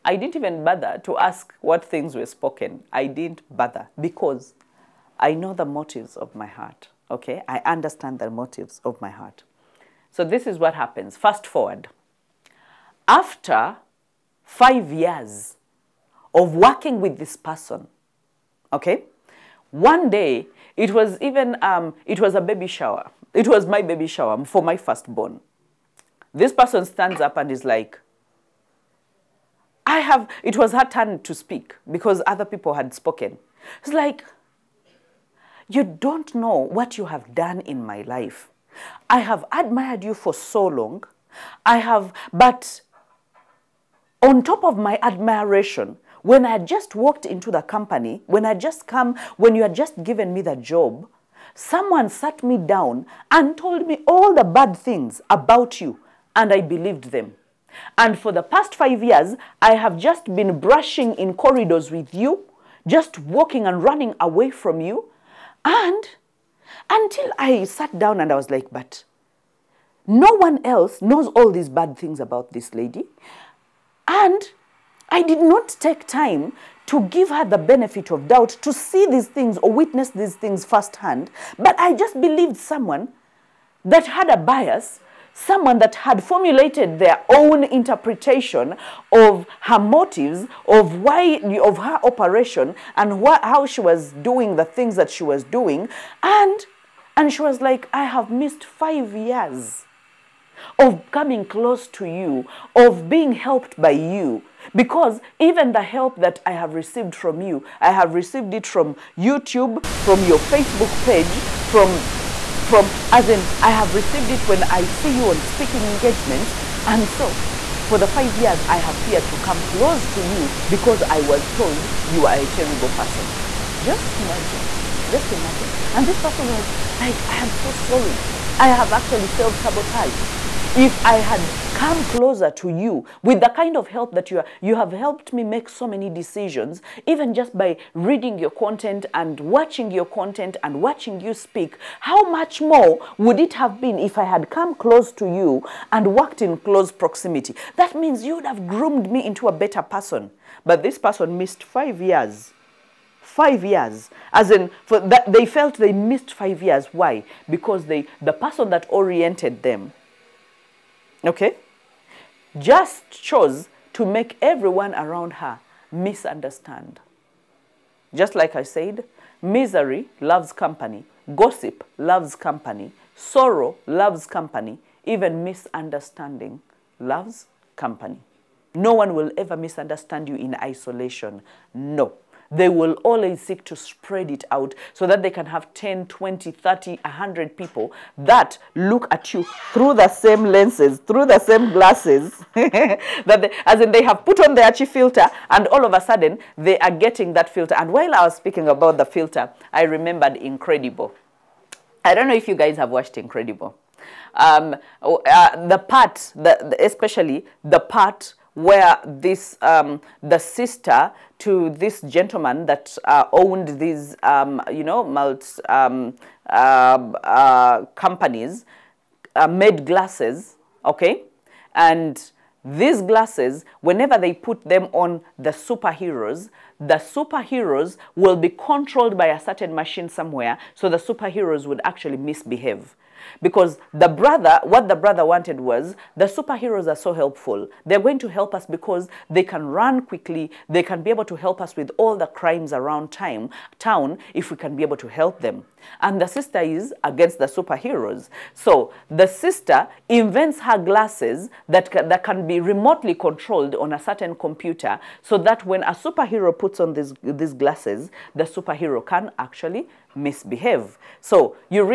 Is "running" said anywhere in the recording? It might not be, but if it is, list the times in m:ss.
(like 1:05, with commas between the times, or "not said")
1:03.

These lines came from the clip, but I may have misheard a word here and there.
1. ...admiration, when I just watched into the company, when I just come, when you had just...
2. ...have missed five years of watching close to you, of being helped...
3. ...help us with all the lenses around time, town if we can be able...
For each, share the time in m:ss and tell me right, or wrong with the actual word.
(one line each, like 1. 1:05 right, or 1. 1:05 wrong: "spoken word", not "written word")
1. 0:45 wrong: "walked", not "watched"
2. 1:38 wrong: "coming", not "watching"
3. 4:01 wrong: "crimes", not "lenses".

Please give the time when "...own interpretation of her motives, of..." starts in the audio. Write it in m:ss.
1:27.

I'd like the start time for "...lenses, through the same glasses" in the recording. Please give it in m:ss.
3:10.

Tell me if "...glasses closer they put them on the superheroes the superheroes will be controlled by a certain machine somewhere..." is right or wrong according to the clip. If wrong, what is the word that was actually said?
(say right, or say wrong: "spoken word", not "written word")
wrong: "whenever", not "closer".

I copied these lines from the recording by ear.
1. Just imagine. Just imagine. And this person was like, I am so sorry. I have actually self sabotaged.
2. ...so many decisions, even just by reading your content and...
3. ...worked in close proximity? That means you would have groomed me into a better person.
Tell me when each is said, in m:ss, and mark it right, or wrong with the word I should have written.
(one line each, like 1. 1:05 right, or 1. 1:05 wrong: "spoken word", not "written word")
1. 2:03 right
2. 2:15 right
3. 2:26 right.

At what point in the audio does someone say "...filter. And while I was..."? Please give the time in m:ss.
3:17.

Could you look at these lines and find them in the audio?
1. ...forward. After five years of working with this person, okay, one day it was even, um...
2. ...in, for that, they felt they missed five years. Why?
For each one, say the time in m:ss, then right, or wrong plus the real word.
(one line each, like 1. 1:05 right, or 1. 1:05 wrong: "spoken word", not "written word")
1. 0:11 right
2. 2:34 right.